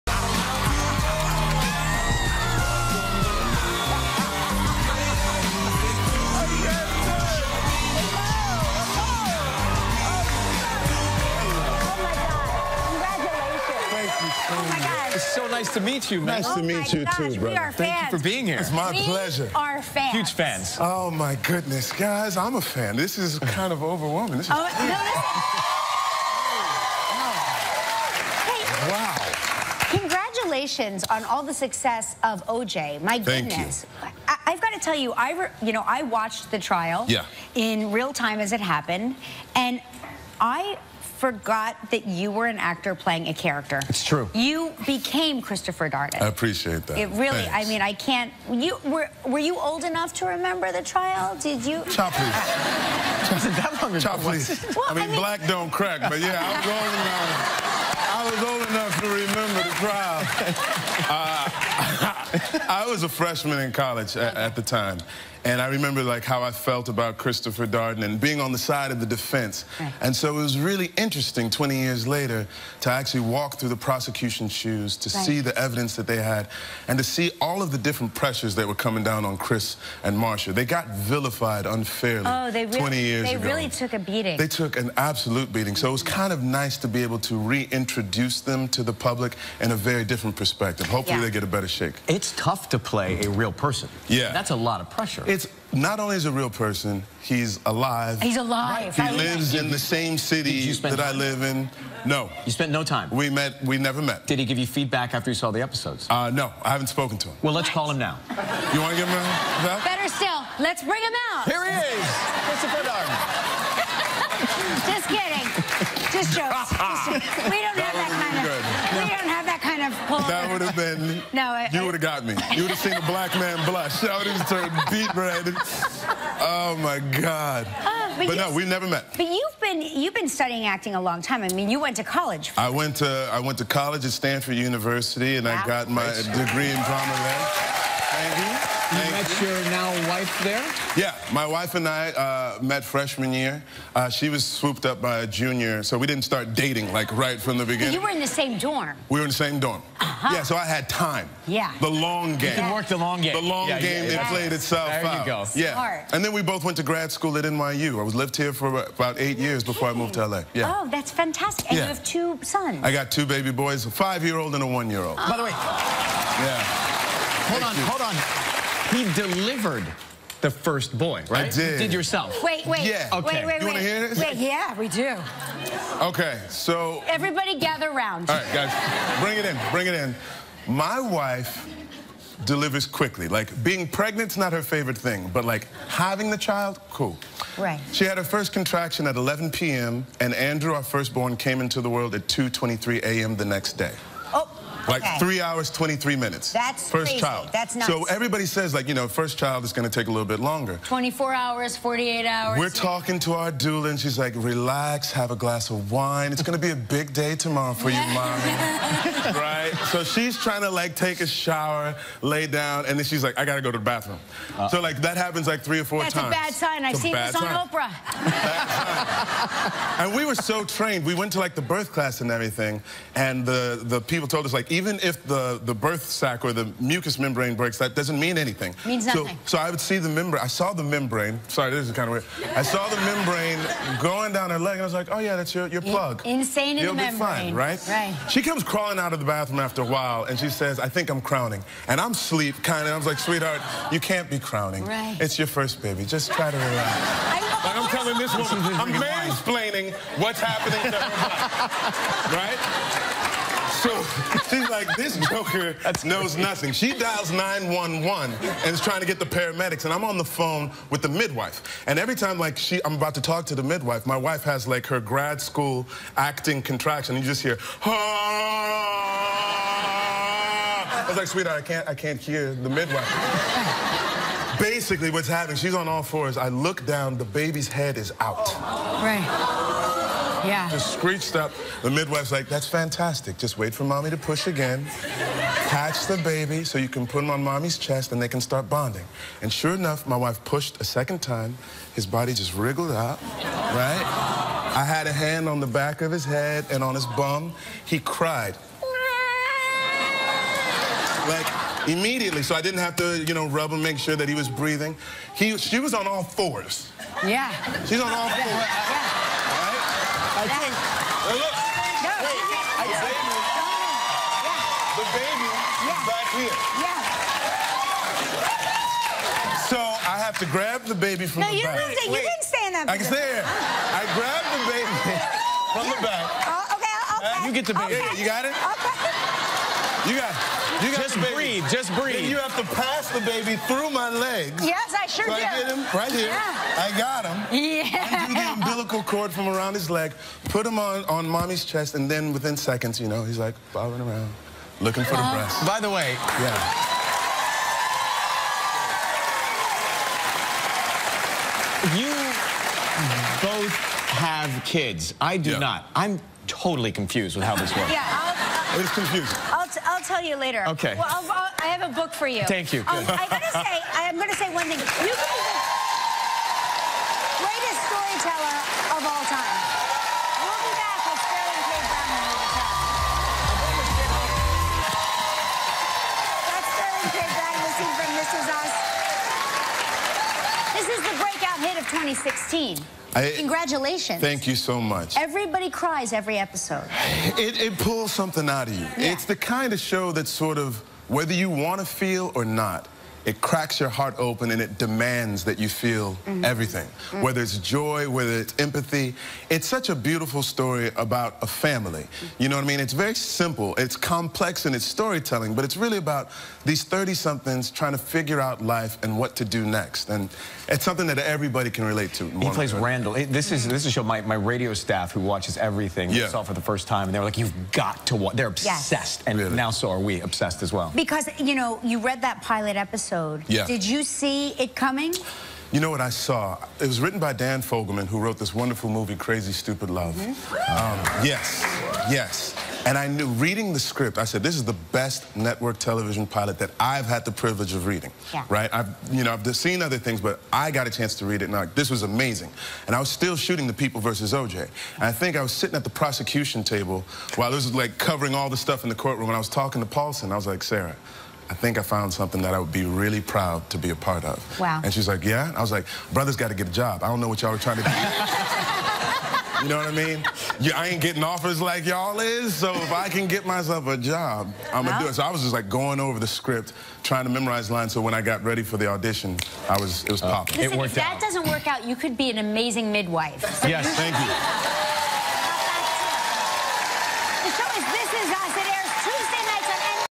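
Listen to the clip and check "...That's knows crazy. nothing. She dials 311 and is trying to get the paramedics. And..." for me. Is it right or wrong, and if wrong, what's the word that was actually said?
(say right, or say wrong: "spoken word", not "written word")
wrong: "911", not "311".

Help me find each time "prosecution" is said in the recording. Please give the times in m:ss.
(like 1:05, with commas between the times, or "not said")
1:13, 7:25.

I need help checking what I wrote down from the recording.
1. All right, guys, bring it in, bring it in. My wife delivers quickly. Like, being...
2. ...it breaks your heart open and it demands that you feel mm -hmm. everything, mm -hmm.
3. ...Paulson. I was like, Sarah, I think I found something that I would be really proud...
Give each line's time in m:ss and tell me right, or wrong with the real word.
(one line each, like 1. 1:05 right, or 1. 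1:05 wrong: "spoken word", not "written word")
1. 2:58 right
2. 6:33 wrong: "cracks", not "breaks"
3. 7:29 right.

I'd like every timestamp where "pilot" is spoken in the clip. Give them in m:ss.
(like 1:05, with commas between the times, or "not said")
7:02, 7:16.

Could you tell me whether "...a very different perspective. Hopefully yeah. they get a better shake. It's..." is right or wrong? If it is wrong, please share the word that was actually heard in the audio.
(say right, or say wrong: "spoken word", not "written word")
right.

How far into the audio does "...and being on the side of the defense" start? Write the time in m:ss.
1:08.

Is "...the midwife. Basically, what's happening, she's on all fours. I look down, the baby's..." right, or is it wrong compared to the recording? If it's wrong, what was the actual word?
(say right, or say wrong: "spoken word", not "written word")
right.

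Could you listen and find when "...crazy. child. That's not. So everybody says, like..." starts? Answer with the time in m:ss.
3:17.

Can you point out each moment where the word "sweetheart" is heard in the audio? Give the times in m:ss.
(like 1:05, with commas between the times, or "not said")
4:03, 4:31.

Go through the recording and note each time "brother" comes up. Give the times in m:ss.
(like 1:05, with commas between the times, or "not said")
0:17, 7:36.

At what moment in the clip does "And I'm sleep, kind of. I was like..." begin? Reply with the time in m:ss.
4:01.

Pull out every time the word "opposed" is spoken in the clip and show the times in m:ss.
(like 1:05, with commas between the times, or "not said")
not said.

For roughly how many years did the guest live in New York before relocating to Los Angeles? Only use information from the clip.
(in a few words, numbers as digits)
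8.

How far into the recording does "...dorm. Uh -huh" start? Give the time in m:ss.
2:29.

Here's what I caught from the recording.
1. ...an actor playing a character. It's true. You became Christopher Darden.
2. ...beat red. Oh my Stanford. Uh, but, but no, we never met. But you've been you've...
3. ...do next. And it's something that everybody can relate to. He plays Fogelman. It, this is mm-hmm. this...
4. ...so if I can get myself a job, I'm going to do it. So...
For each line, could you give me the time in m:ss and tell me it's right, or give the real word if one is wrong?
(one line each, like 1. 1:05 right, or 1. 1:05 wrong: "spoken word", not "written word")
1. 0:42 right
2. 2:04 wrong: "God", not "Stanford"
3. 6:49 wrong: "Randall", not "Fogelman"
4. 7:42 right.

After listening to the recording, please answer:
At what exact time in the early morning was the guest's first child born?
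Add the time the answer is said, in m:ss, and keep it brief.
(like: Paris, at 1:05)
2:23 a.m., at 3:12.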